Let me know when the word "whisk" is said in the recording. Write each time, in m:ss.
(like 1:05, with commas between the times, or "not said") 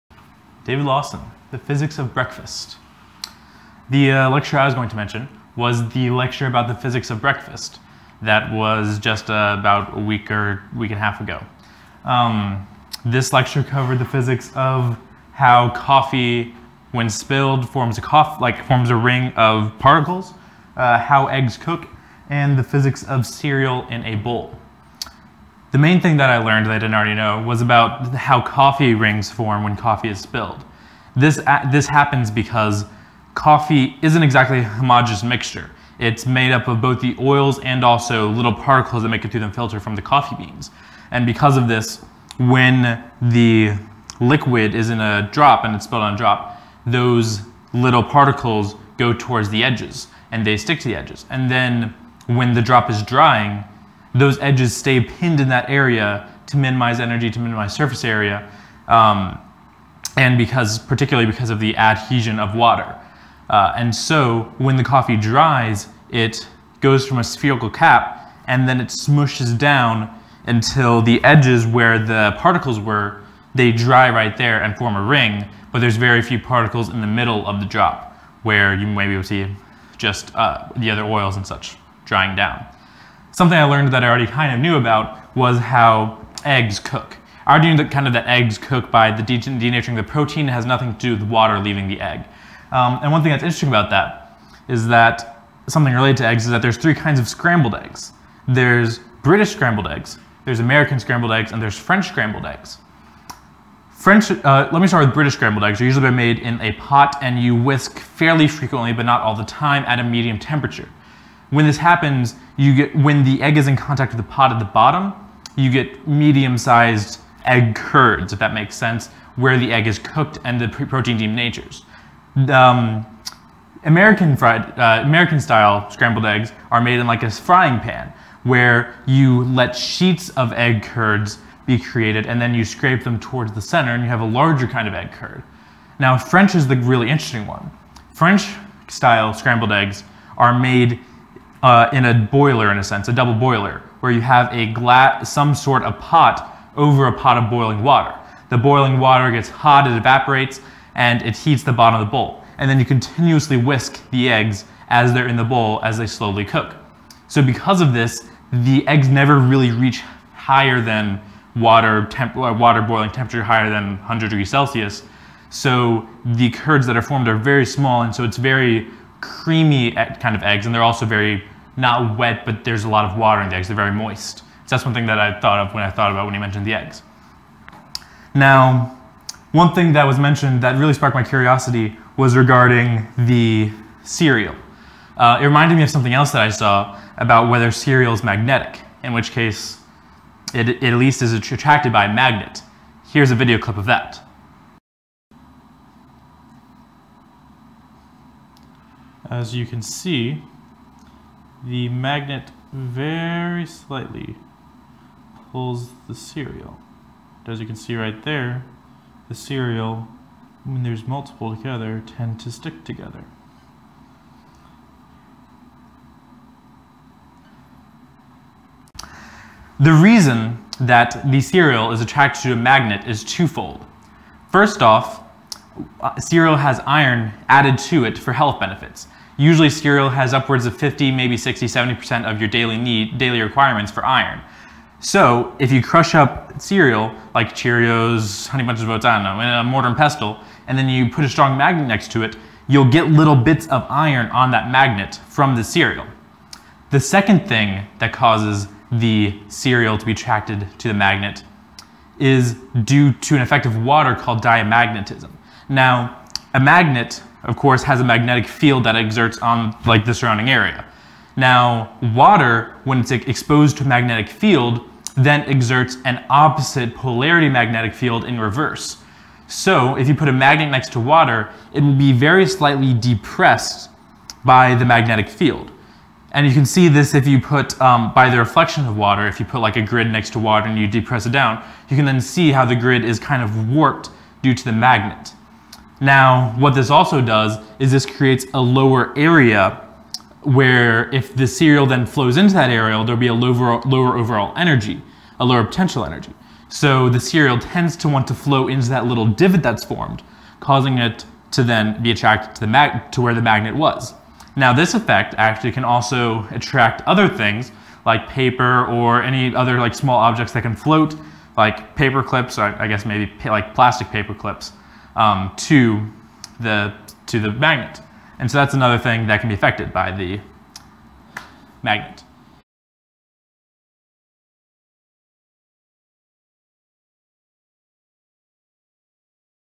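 1:47, 2:33.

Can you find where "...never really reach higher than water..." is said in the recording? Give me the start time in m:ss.
2:39.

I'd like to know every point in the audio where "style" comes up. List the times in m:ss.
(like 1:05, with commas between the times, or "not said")
2:05, 2:18.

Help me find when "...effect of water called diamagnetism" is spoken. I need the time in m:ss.
4:13.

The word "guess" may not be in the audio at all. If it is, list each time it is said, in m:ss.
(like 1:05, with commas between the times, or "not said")
5:12.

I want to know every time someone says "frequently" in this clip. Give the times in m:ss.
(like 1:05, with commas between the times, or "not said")
1:48.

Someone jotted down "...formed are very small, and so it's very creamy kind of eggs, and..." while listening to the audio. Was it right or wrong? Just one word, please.
right.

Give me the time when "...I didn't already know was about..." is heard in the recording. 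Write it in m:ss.
0:26.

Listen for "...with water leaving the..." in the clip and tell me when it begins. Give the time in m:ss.
1:31.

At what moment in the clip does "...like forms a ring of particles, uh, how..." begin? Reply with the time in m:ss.
0:18.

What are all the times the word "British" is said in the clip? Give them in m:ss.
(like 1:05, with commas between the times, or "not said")
1:39, 1:45.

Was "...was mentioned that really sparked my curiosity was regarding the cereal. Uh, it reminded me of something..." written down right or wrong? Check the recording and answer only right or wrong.
right.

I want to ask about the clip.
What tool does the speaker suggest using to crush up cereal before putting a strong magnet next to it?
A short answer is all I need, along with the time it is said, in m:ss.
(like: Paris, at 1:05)
mortar and pestle, at 3:59.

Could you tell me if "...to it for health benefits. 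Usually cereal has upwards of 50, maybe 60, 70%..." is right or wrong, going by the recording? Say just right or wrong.
right.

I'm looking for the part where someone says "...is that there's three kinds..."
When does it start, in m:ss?
1:36.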